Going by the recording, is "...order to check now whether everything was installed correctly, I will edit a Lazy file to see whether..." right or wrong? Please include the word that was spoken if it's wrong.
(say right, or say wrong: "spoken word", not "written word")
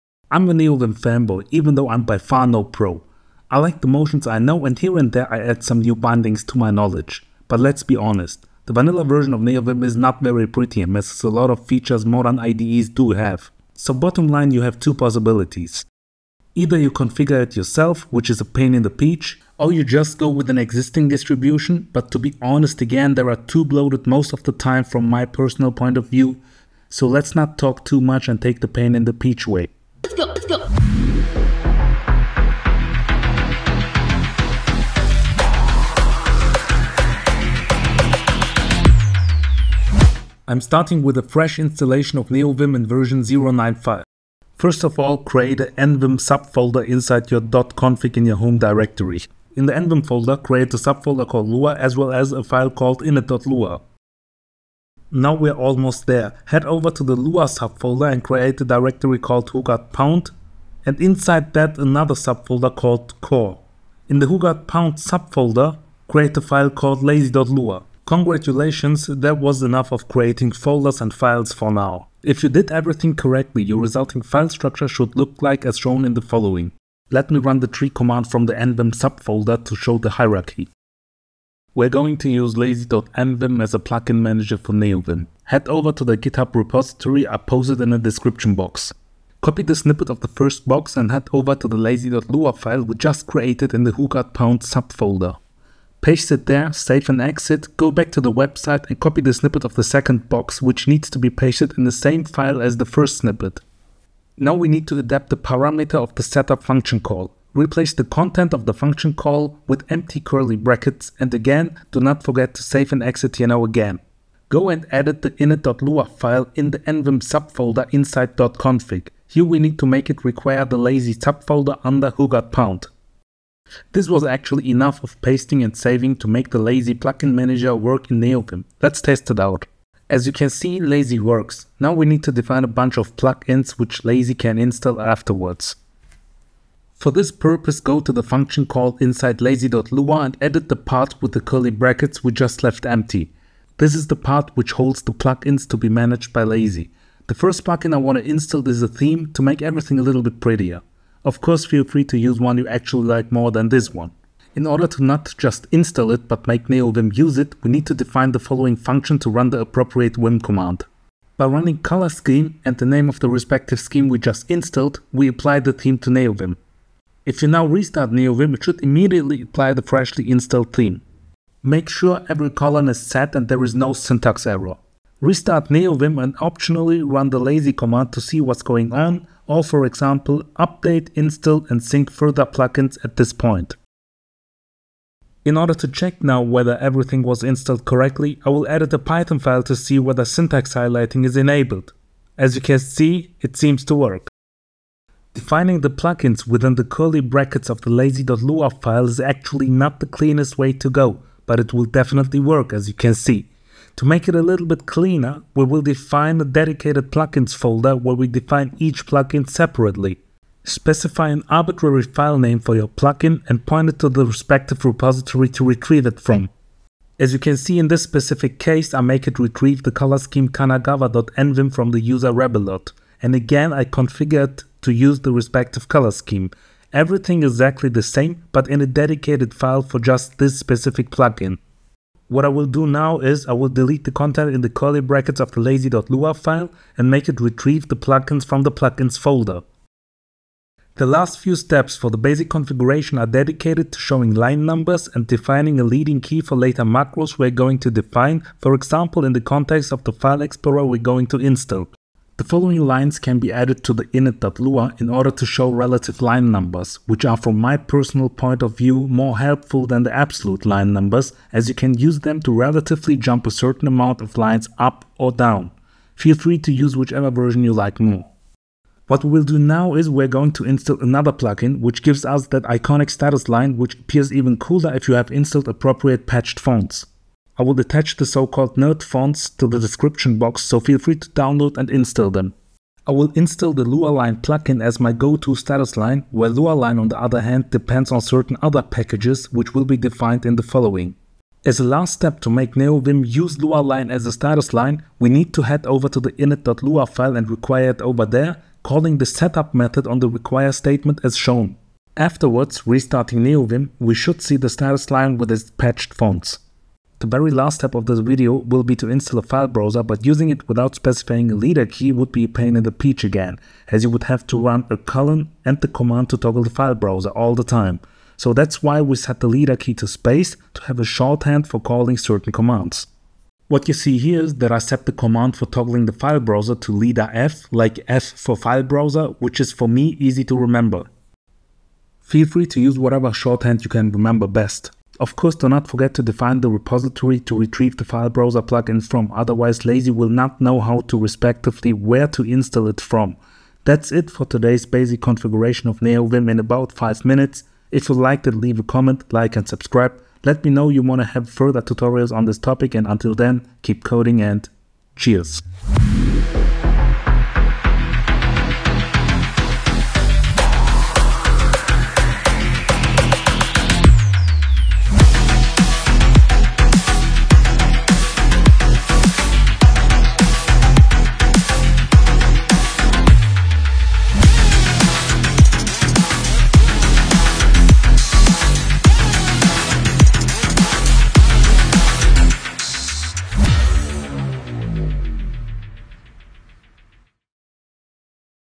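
wrong: "Python", not "Lazy".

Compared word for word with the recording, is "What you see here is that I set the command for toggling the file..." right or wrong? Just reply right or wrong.
right.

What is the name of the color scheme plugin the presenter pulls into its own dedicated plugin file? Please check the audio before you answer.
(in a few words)
kanagawa.nvim.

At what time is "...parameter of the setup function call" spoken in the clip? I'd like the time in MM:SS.
01:45.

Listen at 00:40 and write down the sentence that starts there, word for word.
I'm starting with a fresh installation of NeoVim in version 0.95.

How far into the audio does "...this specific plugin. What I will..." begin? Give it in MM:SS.
03:50.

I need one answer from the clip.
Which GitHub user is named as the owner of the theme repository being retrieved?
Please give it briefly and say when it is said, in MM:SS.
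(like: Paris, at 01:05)
rebelot, at 03:42.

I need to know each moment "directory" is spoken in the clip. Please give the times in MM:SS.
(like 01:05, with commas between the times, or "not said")
00:48, 00:58.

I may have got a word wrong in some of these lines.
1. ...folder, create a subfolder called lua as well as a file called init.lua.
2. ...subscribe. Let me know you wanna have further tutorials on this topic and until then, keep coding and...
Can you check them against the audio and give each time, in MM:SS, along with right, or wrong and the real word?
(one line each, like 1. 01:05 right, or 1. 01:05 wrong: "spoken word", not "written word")
1. 00:50 right
2. 05:49 right.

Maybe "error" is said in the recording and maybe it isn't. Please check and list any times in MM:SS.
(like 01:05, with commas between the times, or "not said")
02:54.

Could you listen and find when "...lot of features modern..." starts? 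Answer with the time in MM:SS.
00:11.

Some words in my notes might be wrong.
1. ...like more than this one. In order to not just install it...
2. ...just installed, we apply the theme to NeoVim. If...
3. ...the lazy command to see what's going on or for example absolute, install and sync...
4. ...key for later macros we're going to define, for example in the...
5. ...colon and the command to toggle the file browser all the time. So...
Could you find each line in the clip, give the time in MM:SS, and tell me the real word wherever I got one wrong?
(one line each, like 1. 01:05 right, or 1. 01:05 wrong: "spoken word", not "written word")
1. 02:33 right
2. 02:44 right
3. 02:57 wrong: "update", not "absolute"
4. 04:06 right
5. 05:14 right.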